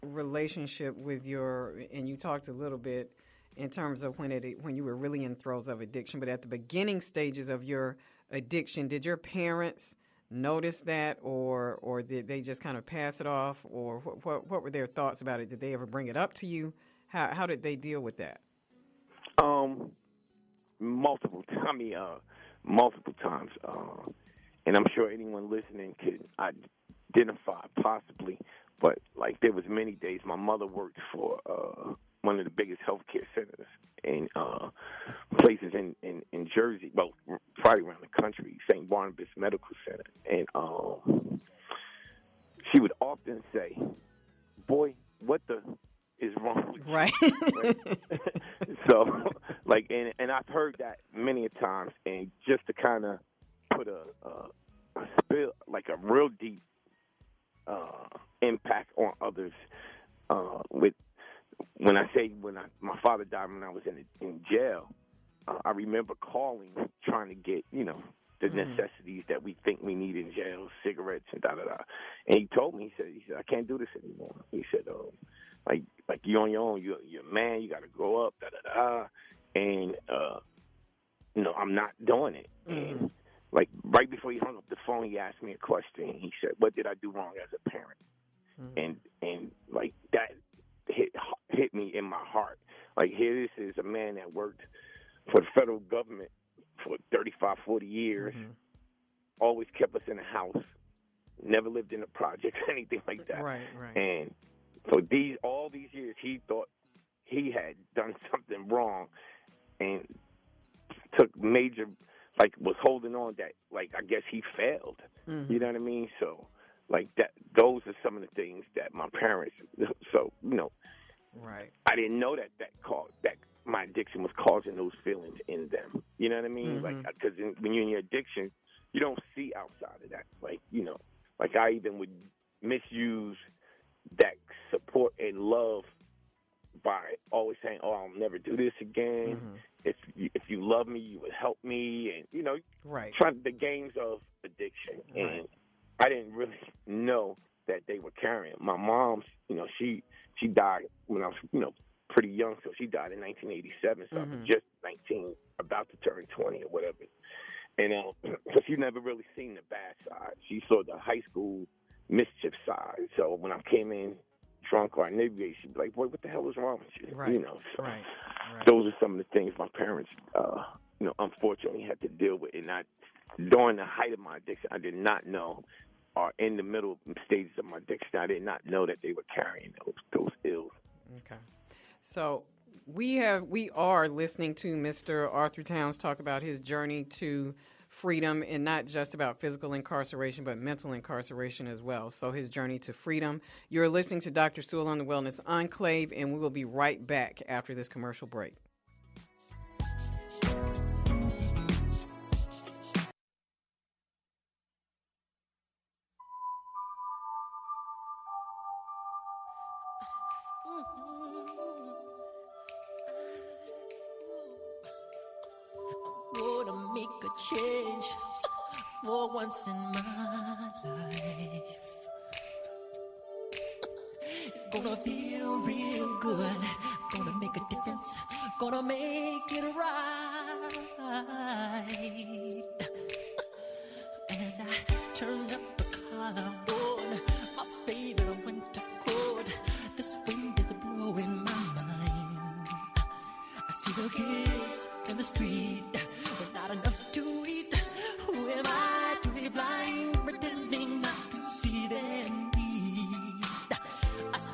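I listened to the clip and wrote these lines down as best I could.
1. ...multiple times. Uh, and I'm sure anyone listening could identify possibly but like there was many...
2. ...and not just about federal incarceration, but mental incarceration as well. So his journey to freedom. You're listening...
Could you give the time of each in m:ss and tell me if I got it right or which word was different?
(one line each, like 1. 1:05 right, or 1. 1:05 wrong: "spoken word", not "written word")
1. 0:22 right
2. 3:08 wrong: "physical", not "federal".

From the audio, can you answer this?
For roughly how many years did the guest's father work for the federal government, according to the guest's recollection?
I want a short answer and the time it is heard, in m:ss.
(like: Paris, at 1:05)
35 to 40, at 1:37.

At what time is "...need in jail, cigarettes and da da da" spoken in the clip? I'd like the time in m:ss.
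1:09.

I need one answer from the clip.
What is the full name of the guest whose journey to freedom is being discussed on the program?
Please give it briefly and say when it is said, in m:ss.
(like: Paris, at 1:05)
Arthur Towns, at 3:05.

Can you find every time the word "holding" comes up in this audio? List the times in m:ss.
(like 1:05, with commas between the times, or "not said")
1:52.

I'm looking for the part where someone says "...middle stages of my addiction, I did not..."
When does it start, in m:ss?
2:56.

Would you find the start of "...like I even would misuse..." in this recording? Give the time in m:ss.
2:11.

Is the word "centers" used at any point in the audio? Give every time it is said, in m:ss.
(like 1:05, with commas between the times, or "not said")
0:33, 0:39.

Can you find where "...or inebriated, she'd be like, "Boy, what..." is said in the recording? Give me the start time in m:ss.
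2:44.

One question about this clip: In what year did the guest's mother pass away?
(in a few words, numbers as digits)
1987.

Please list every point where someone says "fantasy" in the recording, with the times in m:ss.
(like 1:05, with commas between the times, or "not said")
not said.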